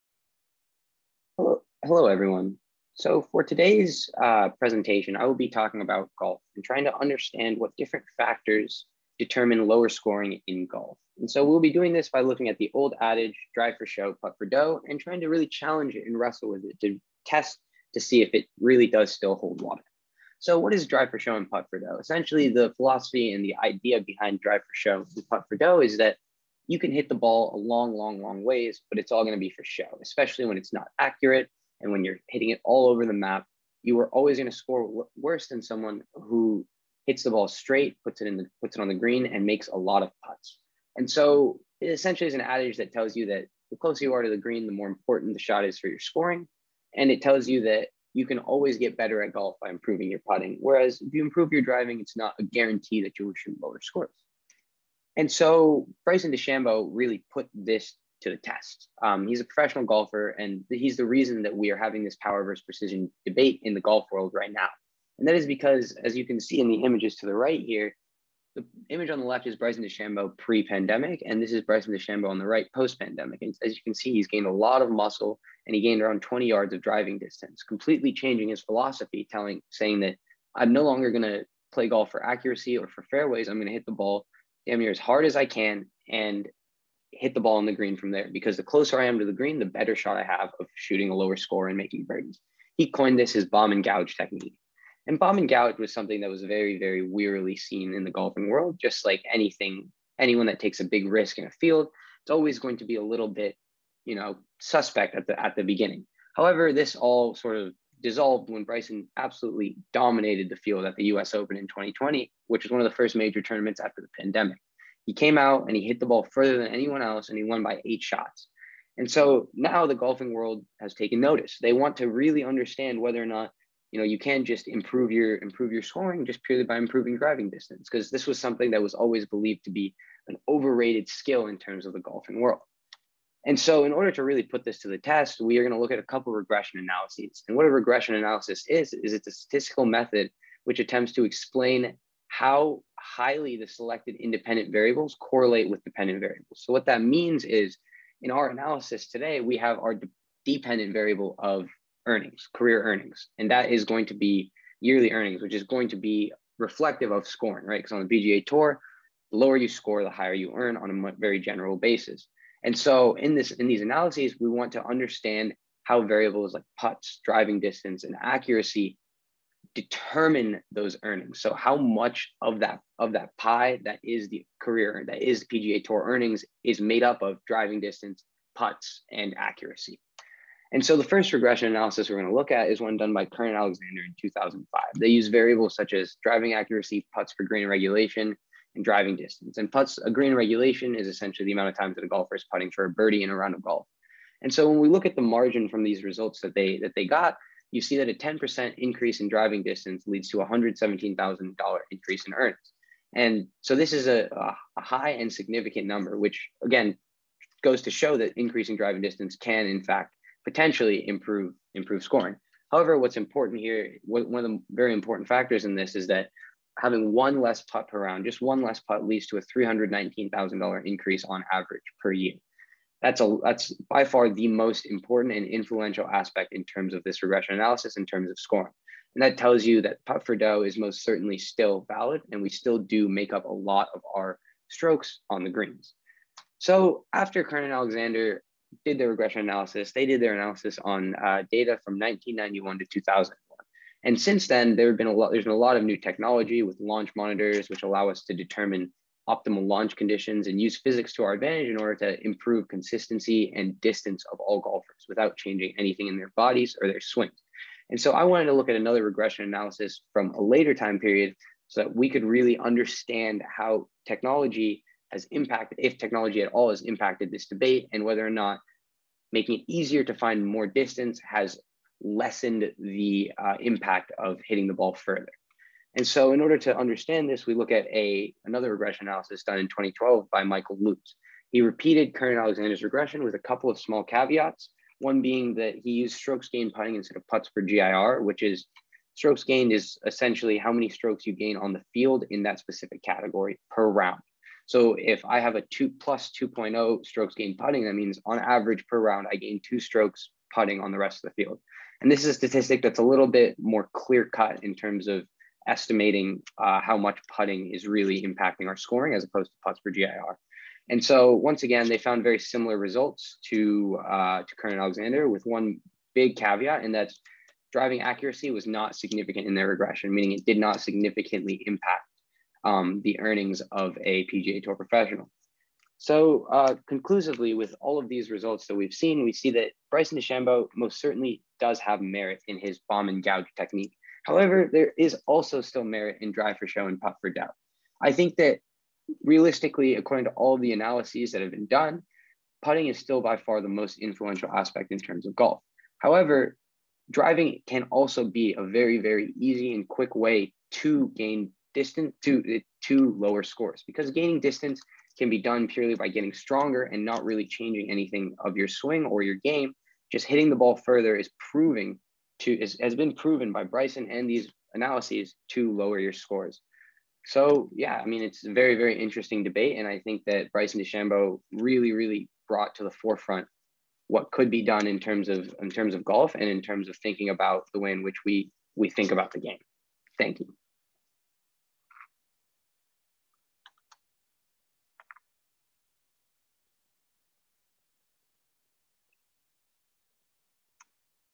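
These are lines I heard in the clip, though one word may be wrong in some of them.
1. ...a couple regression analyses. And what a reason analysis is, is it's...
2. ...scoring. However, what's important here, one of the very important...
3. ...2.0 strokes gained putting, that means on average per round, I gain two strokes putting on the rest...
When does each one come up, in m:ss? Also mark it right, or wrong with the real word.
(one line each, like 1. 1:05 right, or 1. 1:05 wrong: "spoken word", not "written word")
1. 2:15 wrong: "regression", not "reason"
2. 3:32 right
3. 4:56 right.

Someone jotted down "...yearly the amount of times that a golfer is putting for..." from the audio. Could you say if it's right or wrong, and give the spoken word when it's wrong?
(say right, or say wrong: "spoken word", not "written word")
wrong: "essentially", not "yearly".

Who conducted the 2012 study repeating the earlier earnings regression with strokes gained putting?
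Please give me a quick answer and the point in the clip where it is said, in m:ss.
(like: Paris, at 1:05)
Michael Lutz, at 4:40.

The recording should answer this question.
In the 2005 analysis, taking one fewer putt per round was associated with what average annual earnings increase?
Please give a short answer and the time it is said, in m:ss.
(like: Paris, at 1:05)
$319,000, at 3:39.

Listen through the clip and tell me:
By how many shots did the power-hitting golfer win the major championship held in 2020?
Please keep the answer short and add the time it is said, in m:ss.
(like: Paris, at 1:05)
8, at 1:57.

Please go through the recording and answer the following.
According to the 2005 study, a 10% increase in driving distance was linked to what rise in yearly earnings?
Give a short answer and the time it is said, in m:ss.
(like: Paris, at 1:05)
$117,000, at 3:20.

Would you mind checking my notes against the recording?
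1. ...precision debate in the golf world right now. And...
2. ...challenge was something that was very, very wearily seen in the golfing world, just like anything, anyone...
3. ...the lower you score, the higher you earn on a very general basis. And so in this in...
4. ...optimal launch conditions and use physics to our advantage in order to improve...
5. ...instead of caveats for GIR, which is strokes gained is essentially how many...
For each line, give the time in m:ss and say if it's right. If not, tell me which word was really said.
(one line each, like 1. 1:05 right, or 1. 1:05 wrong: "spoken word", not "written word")
1. 1:02 right
2. 1:35 wrong: "gouge", not "challenge"
3. 2:39 right
4. 4:09 right
5. 4:46 wrong: "putts", not "caveats".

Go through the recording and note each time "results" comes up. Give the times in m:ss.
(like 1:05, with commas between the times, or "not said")
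3:16, 5:12, 5:28.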